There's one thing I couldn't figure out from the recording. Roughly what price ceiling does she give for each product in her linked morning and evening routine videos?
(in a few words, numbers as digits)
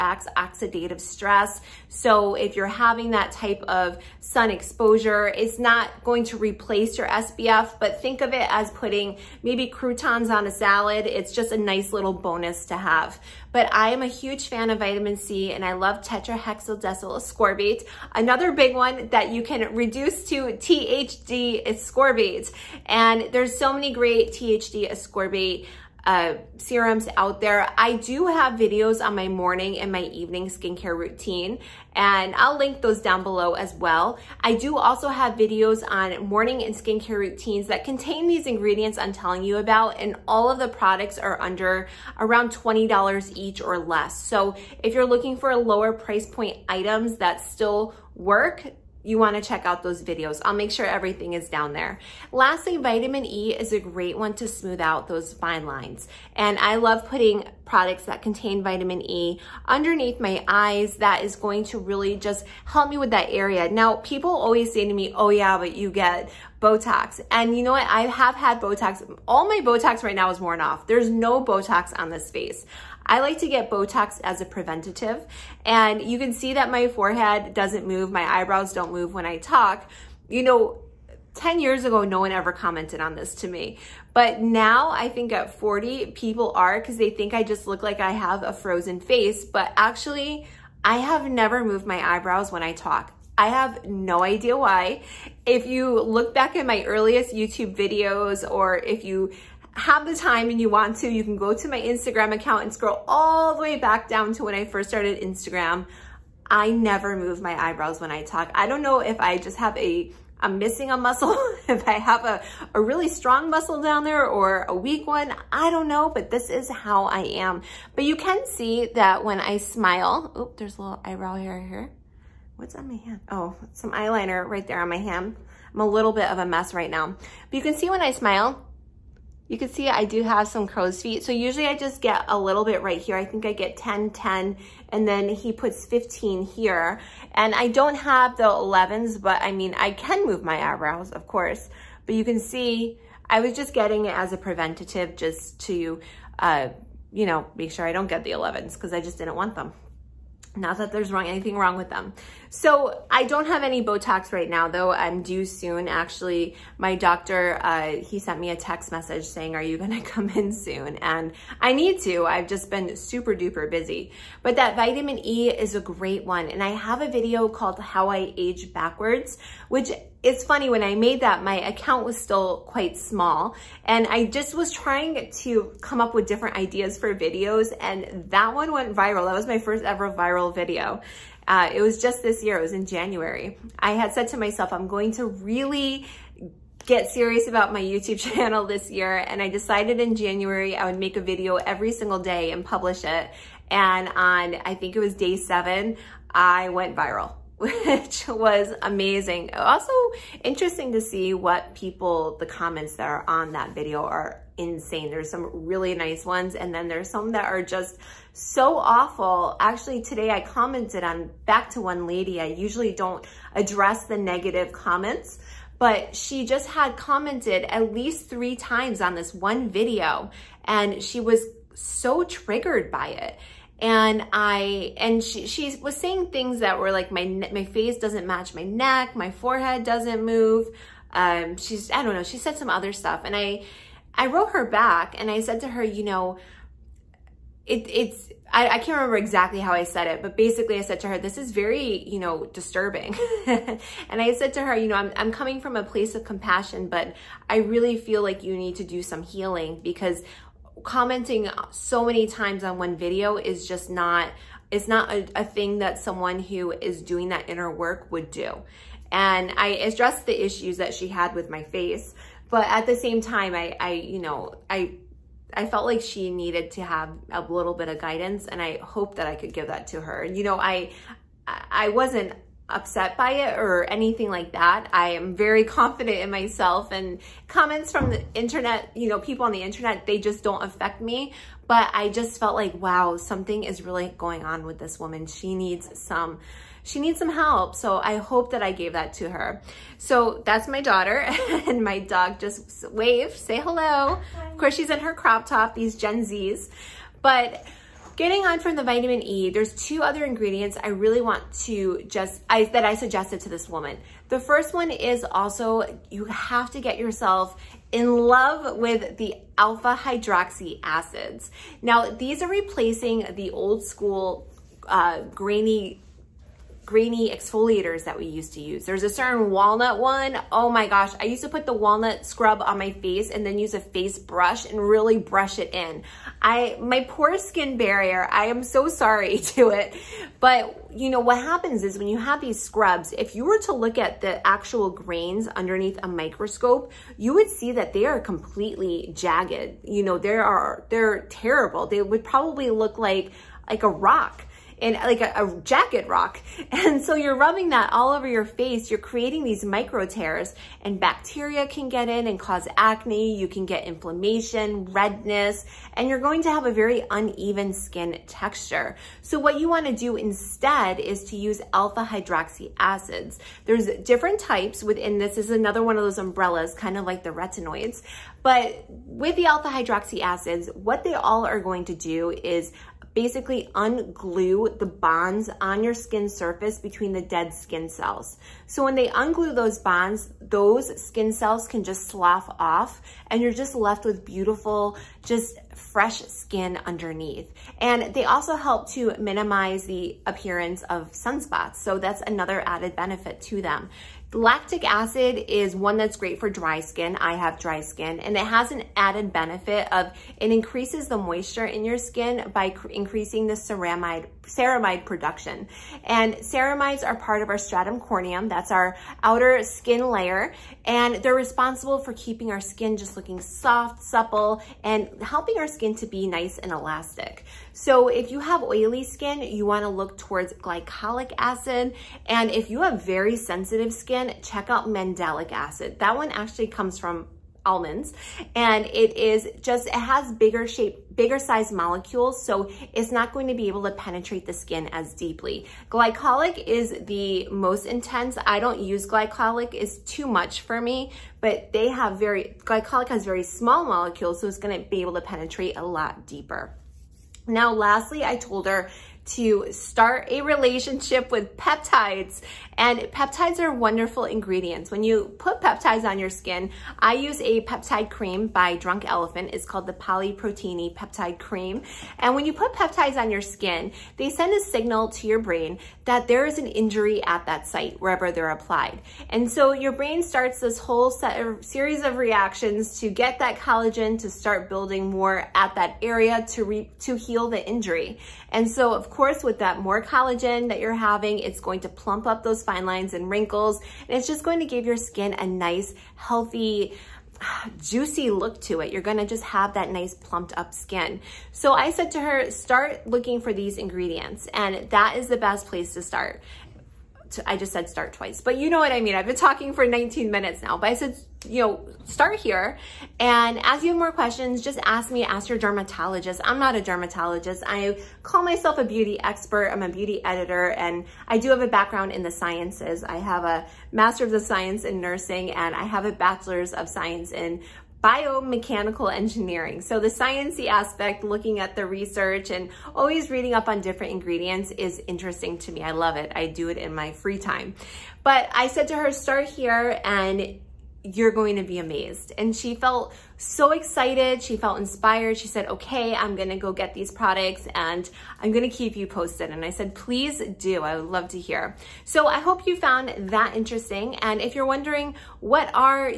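$20.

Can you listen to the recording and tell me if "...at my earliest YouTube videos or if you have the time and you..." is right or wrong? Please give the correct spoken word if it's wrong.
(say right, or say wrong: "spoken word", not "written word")
right.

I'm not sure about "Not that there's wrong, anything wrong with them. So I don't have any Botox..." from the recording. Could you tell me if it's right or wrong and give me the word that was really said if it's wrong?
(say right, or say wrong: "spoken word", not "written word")
right.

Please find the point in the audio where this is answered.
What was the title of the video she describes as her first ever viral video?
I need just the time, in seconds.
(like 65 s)
167 s.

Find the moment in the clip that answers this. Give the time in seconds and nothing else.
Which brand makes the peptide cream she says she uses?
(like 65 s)
458 s.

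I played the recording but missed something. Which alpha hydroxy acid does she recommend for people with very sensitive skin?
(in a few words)
mandelic acid.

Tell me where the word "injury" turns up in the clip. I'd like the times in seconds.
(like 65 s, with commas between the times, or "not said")
466 s, 477 s.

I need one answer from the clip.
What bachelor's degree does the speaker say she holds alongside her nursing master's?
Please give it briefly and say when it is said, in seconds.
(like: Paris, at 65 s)
biomechanical engineering, at 518 s.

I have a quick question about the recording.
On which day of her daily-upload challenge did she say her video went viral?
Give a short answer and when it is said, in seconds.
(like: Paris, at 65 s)
7, at 195 s.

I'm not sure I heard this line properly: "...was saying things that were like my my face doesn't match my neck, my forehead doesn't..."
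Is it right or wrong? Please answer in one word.
right.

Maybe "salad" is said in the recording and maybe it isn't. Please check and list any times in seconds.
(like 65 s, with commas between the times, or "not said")
10 s.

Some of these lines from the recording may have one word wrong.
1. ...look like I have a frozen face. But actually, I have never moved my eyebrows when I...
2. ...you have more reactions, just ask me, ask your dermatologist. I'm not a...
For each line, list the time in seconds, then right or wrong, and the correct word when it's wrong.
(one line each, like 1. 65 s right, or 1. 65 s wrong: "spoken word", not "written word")
1. 87 s right
2. 503 s wrong: "questions", not "reactions".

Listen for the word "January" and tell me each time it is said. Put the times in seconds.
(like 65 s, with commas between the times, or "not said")
182 s, 190 s.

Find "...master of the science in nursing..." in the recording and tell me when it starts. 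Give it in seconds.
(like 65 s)
513 s.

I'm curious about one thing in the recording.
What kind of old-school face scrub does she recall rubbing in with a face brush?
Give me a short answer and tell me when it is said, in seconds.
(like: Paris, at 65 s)
walnut scrub, at 321 s.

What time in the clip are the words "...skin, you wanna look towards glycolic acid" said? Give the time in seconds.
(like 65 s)
419 s.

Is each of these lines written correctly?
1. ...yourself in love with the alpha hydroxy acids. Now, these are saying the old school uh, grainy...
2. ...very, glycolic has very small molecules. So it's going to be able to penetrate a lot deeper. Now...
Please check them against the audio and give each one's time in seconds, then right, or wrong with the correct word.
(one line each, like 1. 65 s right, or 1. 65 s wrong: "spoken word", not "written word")
1. 306 s wrong: "replacing", not "saying"
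2. 442 s right.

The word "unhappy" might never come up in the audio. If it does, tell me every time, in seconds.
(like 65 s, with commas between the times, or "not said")
not said.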